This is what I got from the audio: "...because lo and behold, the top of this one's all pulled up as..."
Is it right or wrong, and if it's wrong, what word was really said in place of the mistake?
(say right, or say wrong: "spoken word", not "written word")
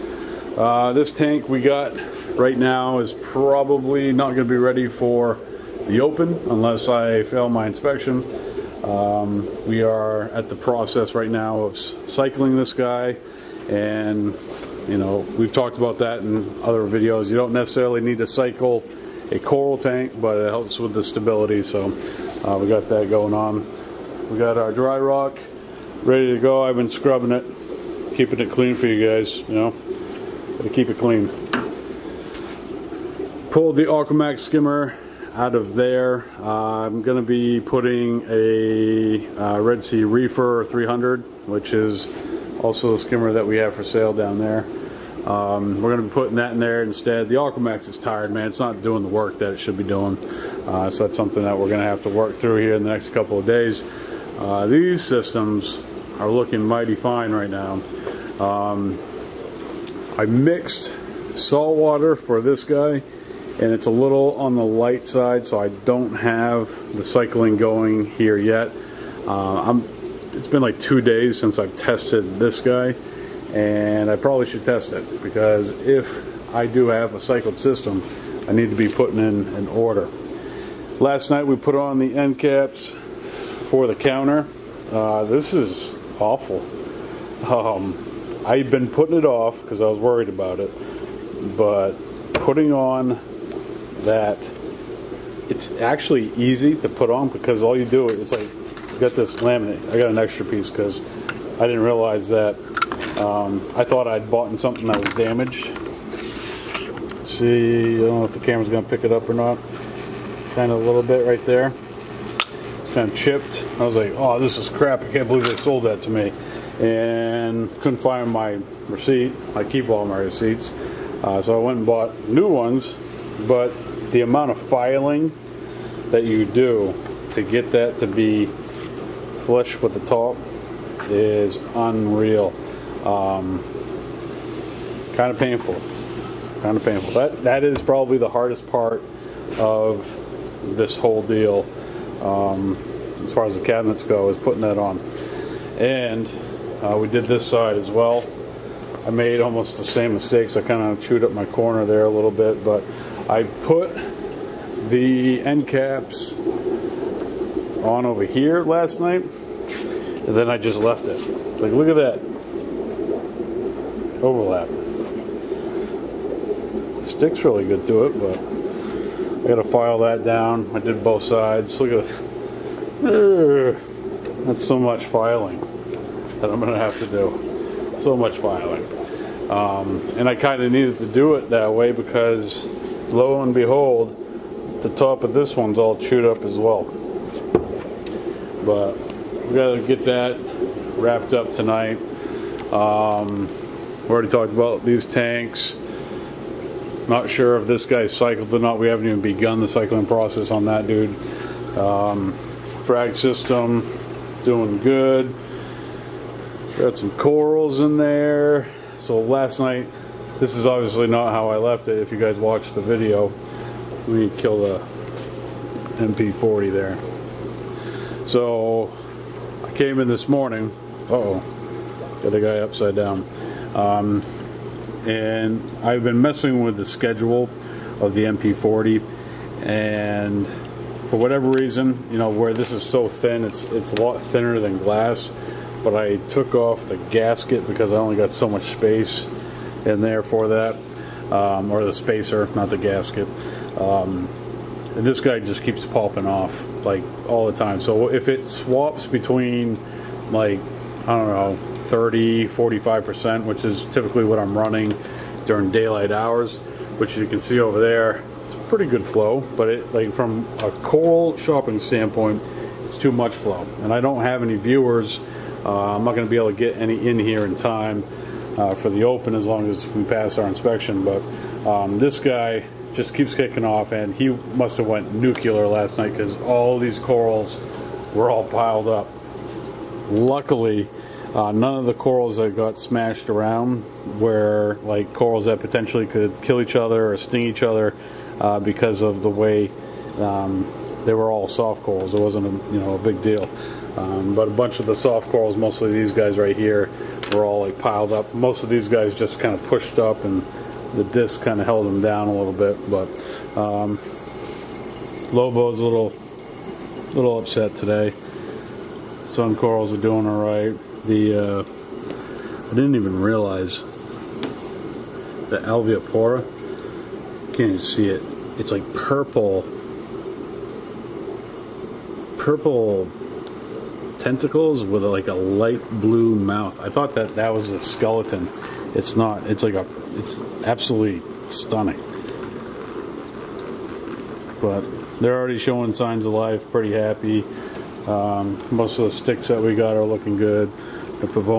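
wrong: "chewed", not "pulled".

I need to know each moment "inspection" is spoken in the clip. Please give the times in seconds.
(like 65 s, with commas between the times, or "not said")
7 s, 270 s.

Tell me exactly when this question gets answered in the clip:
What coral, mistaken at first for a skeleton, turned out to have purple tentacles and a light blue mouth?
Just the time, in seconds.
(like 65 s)
315 s.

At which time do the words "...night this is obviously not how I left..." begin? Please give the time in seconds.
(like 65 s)
209 s.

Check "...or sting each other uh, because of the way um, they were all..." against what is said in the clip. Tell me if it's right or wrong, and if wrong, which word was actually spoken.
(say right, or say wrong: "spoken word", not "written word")
right.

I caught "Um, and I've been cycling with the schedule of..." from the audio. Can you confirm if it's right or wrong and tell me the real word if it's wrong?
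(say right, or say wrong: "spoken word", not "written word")
wrong: "messing", not "cycling".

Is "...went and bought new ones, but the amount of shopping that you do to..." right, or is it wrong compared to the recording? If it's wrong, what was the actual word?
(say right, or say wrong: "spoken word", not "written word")
wrong: "filing", not "shopping".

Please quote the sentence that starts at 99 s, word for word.
I got an extra piece because I didn't realize that.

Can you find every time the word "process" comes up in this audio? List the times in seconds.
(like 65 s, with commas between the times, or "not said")
10 s, 200 s.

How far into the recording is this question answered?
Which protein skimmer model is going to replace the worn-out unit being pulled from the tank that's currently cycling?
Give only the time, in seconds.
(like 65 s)
39 s.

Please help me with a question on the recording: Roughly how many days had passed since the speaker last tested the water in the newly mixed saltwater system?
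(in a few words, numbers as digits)
2.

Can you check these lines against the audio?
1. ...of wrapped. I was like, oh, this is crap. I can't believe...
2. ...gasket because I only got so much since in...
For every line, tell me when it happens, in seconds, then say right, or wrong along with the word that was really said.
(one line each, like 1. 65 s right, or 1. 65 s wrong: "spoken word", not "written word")
1. 113 s wrong: "chipped", not "wrapped"
2. 237 s wrong: "space", not "since".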